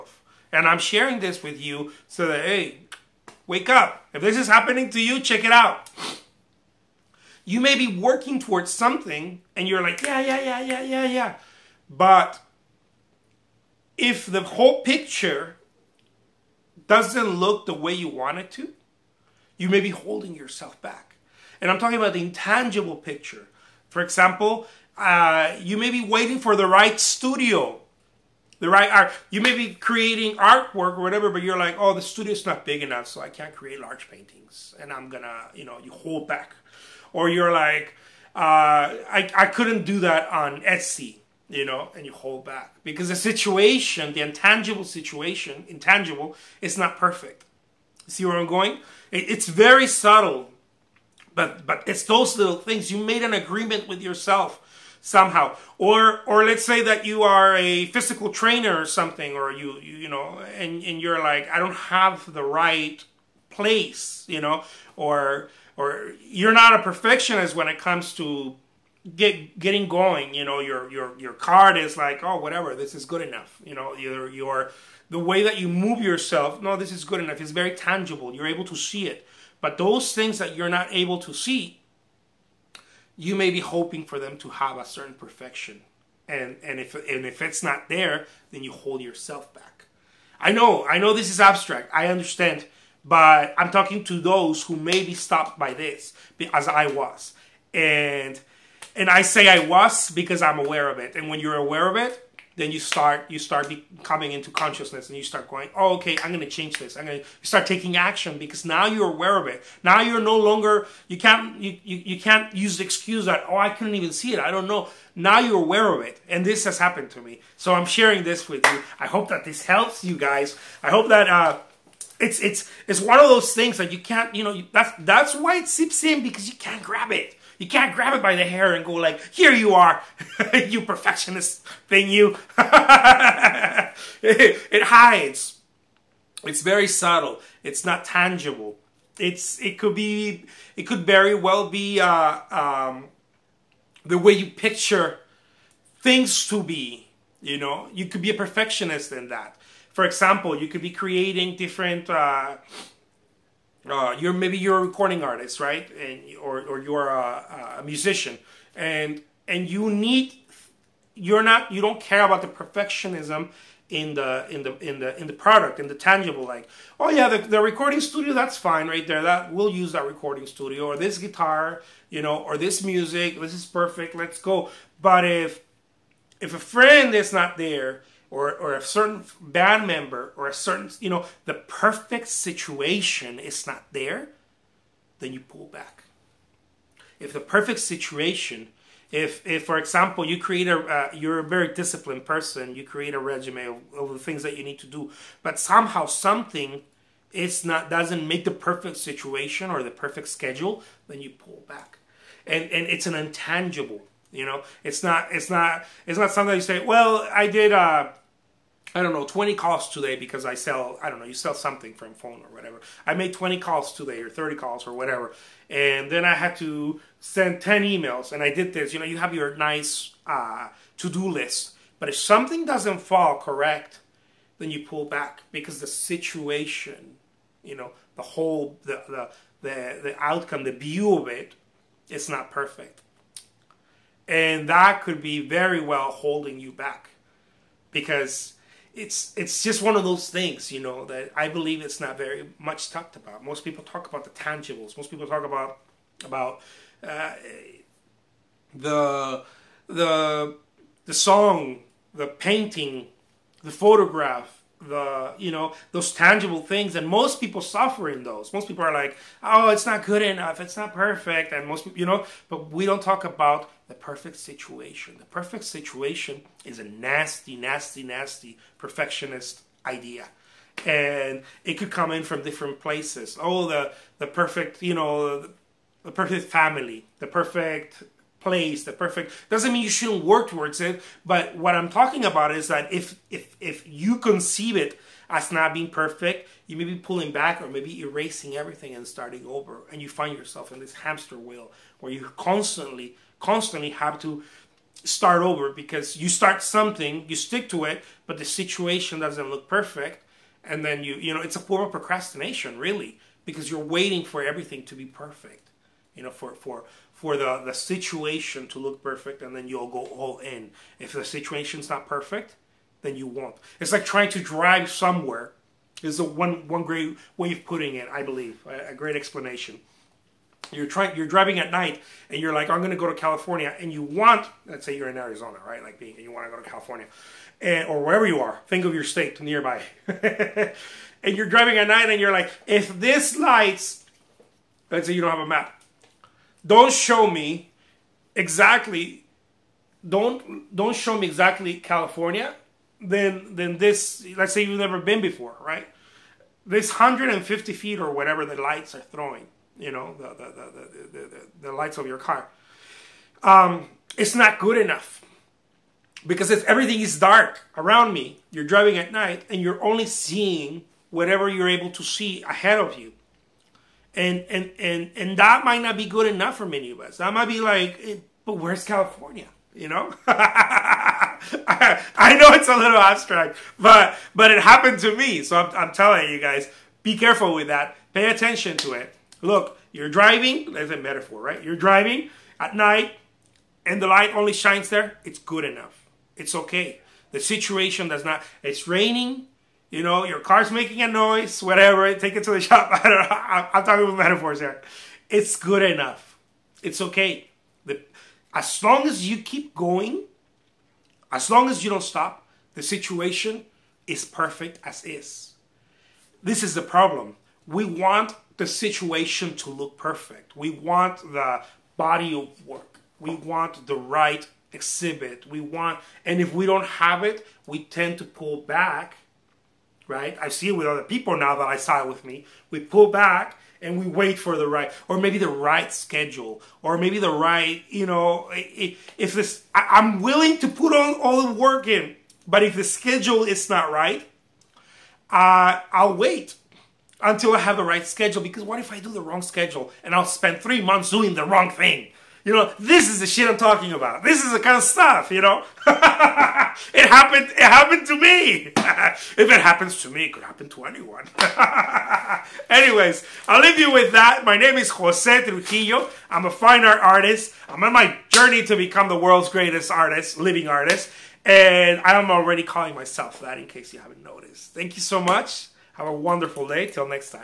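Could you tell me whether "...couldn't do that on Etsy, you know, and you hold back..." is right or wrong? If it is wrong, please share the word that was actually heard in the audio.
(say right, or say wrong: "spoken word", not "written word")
right.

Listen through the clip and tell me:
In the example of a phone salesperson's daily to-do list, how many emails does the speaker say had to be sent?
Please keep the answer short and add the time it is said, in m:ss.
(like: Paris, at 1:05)
10, at 3:37.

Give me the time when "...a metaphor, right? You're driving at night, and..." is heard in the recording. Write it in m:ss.
6:20.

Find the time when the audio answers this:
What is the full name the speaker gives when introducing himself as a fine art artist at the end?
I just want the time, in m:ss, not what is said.
7:34.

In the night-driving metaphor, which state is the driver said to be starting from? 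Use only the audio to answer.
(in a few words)
Arizona.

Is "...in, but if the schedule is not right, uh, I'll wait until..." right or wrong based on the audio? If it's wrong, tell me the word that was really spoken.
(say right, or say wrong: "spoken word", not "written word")
right.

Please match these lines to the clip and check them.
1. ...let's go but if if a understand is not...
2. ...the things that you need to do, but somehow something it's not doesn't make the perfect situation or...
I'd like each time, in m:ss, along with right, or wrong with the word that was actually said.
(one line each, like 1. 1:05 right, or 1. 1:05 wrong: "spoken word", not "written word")
1. 2:54 wrong: "friend", not "understand"
2. 3:14 right.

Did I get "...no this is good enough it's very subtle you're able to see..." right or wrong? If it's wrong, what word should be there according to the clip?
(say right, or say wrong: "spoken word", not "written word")
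wrong: "tangible", not "subtle".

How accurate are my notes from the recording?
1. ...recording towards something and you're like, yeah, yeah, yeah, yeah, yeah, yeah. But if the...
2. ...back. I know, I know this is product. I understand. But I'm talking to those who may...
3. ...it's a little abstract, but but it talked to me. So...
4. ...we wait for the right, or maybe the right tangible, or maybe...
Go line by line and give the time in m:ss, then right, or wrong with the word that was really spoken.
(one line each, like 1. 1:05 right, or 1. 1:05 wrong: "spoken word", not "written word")
1. 0:07 wrong: "working", not "recording"
2. 1:29 wrong: "abstract", not "product"
3. 6:12 wrong: "happened", not "talked"
4. 7:03 wrong: "schedule", not "tangible".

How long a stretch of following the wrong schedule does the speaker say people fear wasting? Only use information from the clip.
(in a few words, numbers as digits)
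3 months.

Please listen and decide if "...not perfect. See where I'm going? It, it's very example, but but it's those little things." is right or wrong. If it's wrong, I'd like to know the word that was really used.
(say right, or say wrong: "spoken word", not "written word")
wrong: "subtle", not "example".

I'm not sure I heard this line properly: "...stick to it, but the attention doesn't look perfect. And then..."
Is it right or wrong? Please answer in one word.
wrong.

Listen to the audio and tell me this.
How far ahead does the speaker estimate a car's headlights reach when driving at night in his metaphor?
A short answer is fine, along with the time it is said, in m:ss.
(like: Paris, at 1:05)
150 feet, at 5:46.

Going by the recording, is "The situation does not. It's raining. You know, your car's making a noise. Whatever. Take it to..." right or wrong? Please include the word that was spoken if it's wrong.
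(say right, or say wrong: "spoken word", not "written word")
right.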